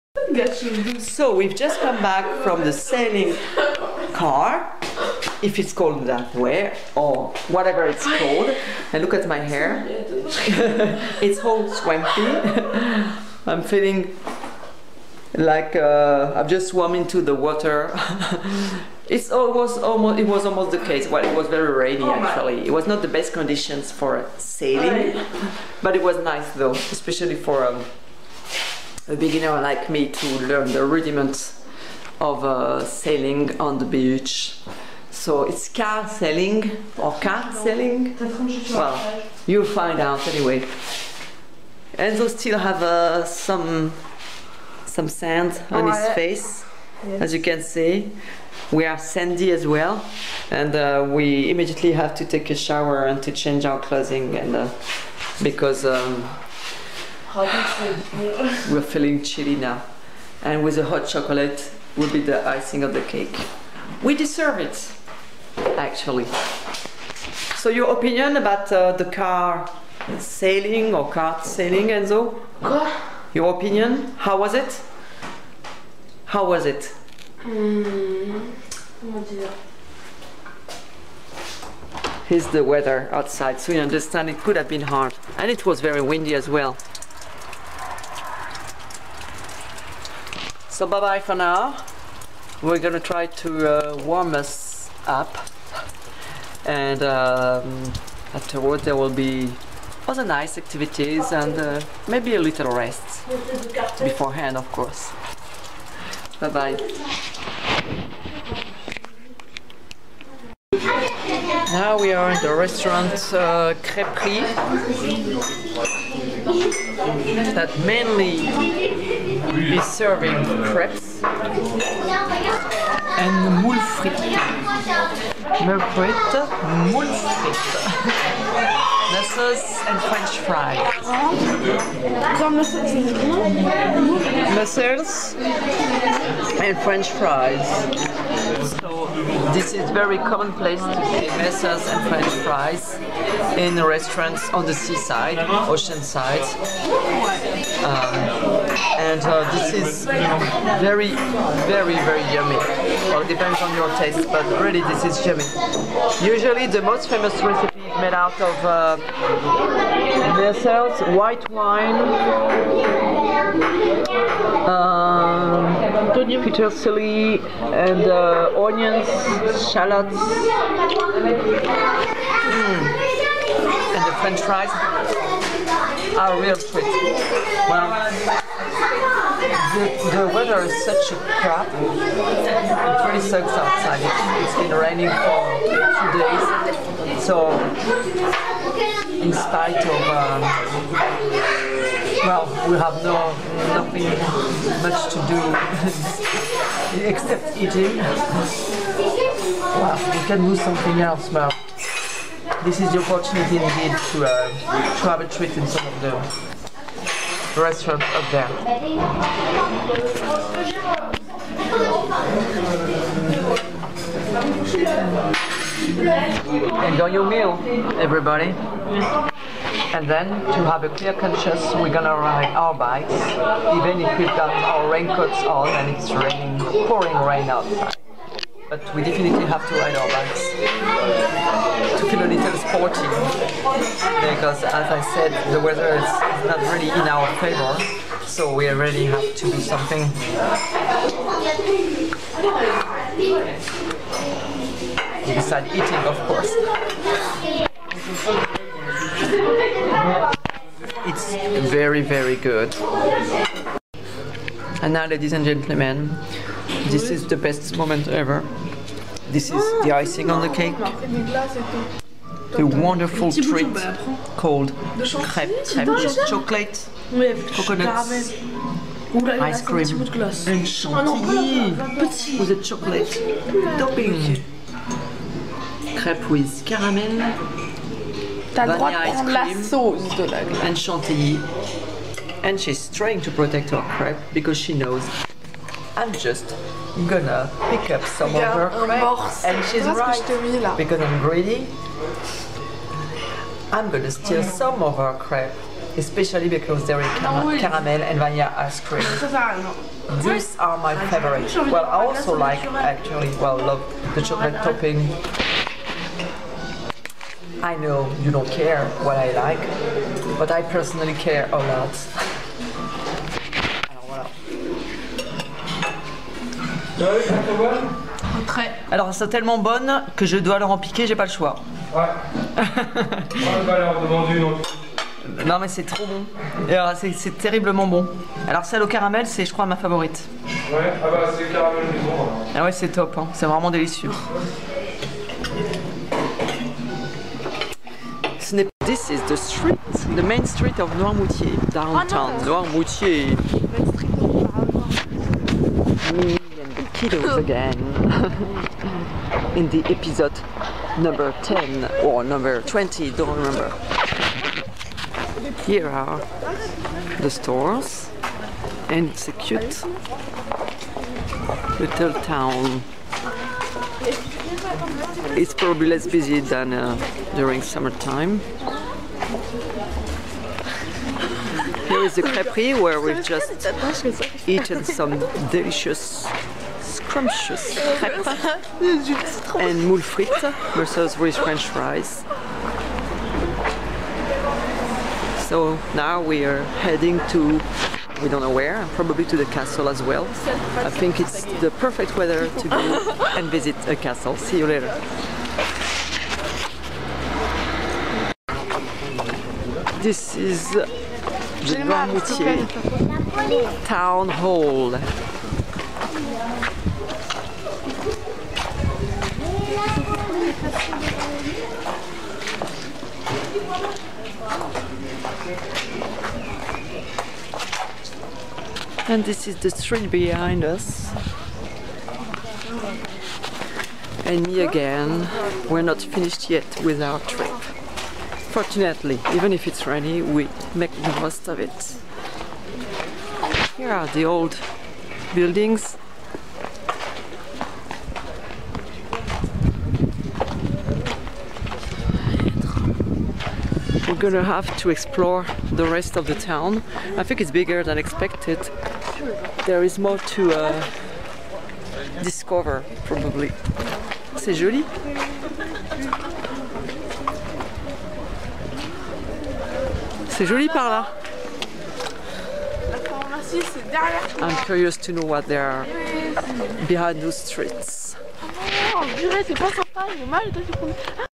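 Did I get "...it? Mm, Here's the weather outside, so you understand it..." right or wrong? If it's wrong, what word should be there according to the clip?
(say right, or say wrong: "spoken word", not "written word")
right.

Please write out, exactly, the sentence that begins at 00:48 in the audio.
We are sandy as well, and uh, we immediately have to take a shower and to change our clothing, and uh, because.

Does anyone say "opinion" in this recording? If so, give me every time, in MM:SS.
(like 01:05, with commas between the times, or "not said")
01:07, 01:13.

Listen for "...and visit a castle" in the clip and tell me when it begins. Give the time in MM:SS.
06:33.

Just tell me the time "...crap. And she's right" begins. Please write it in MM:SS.
04:48.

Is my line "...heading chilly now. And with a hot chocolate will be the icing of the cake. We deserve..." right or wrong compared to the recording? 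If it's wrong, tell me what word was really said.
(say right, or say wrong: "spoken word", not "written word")
wrong: "feeling", not "heading".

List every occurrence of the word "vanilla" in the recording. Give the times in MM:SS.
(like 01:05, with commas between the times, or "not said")
04:38, 04:58.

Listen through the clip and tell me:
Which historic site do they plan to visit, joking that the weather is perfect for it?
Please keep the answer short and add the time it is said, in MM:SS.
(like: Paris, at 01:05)
the castle, at 06:29.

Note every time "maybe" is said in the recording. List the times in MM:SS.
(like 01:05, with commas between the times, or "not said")
01:42.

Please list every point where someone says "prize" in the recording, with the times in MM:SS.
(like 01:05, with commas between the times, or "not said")
not said.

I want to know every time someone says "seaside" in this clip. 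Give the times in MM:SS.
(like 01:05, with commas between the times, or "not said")
02:24.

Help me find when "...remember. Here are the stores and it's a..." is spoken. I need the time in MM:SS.
05:53.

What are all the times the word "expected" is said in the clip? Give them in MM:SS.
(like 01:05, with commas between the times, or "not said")
07:27.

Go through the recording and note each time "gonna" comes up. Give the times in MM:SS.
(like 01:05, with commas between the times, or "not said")
01:32, 03:41, 04:47, 04:53, 07:24.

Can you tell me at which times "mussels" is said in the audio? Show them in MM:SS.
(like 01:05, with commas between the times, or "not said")
02:09, 02:14, 02:21.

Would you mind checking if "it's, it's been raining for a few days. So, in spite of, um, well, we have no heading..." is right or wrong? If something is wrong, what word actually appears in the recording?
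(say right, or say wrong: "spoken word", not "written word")
wrong: "nothing", not "heading".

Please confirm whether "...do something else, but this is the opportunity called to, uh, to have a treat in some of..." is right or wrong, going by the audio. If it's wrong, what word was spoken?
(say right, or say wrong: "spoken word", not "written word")
wrong: "indeed", not "called".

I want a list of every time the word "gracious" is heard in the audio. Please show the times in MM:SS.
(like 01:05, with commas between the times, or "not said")
not said.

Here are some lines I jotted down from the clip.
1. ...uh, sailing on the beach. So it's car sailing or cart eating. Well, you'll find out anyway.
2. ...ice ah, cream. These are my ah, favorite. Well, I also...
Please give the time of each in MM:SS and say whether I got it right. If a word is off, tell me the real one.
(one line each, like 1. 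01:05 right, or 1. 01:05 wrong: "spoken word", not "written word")
1. 00:32 wrong: "sailing", not "eating"
2. 04:58 right.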